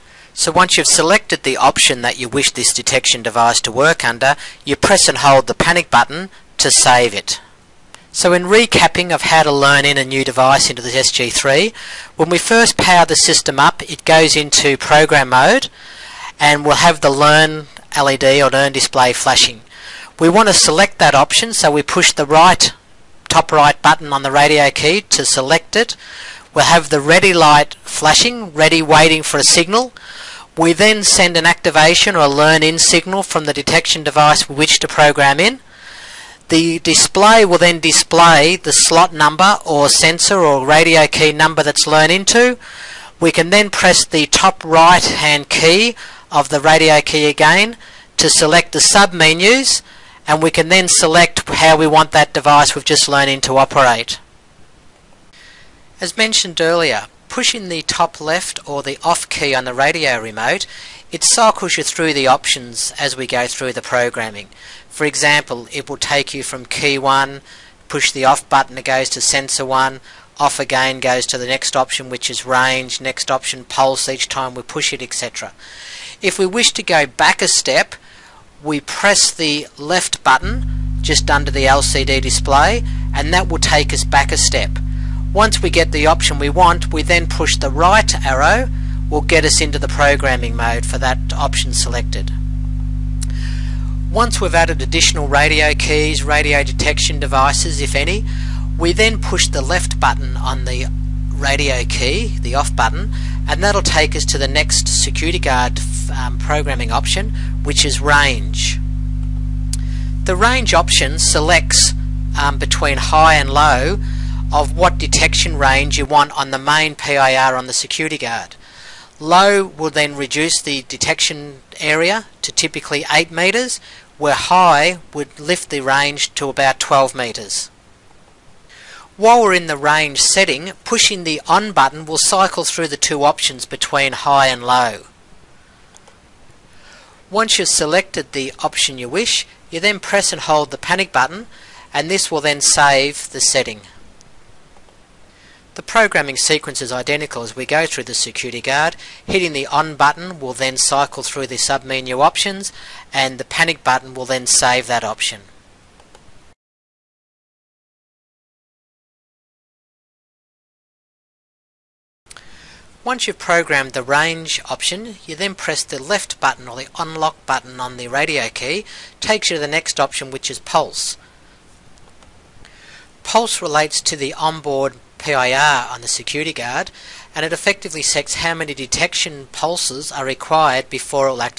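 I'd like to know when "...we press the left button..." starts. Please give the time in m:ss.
1:18.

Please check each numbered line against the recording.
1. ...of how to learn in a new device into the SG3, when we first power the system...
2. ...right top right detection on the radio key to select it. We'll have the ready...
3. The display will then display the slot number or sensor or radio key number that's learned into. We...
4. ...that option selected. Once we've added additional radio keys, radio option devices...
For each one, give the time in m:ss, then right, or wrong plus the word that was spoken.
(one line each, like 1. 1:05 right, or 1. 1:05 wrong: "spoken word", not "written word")
1. 0:09 right
2. 0:22 wrong: "button", not "detection"
3. 0:36 right
4. 1:30 wrong: "detection", not "option".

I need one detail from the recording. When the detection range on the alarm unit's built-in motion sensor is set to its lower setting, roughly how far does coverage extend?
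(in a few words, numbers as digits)
8 metres.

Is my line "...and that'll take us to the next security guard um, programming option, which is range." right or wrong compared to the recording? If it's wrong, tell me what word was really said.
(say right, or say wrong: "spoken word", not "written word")
right.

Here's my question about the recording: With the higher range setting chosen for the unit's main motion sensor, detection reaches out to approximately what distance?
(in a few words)
12 metres.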